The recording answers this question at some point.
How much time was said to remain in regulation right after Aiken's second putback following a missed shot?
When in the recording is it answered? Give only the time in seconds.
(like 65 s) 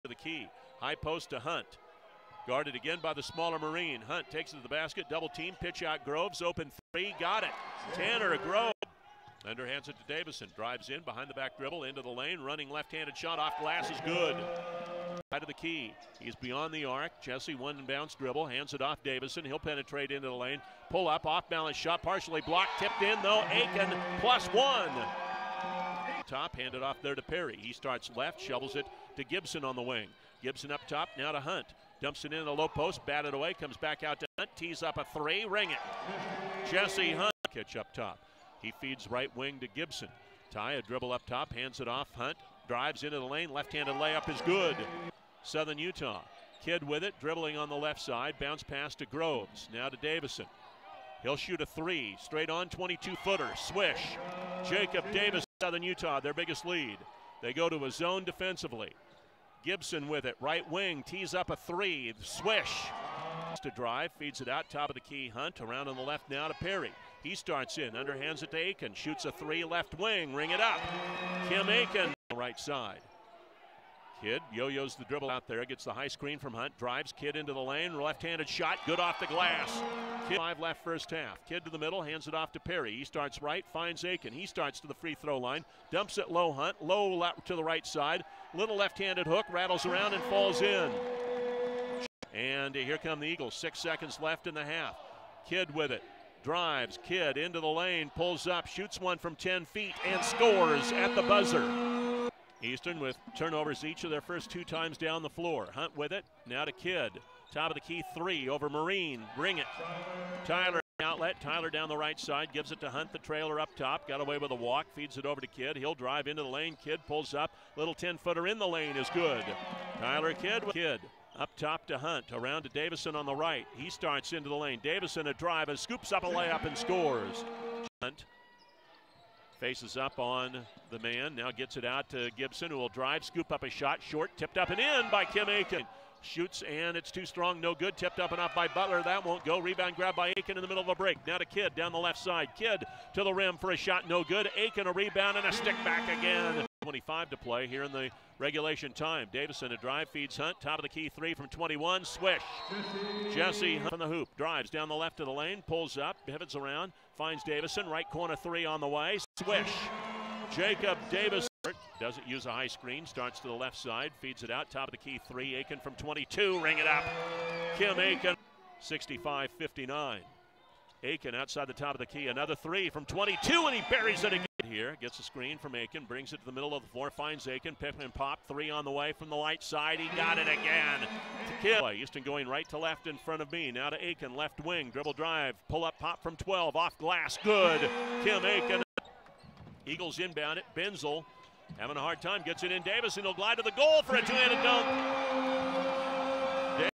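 146 s.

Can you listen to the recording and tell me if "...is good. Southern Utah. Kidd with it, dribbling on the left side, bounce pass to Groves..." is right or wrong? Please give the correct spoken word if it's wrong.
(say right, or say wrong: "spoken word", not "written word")
right.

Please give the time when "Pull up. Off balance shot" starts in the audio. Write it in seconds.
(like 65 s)
20 s.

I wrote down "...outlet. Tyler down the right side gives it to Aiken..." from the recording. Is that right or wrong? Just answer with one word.
wrong.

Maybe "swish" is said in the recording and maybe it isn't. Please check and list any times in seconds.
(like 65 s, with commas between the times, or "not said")
53 s, 62 s, 152 s, 159 s.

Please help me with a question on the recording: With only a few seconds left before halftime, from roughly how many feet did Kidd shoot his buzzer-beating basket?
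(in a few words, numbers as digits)
10.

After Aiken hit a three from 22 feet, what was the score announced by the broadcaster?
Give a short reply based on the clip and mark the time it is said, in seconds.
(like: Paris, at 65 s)
65-59, at 168 s.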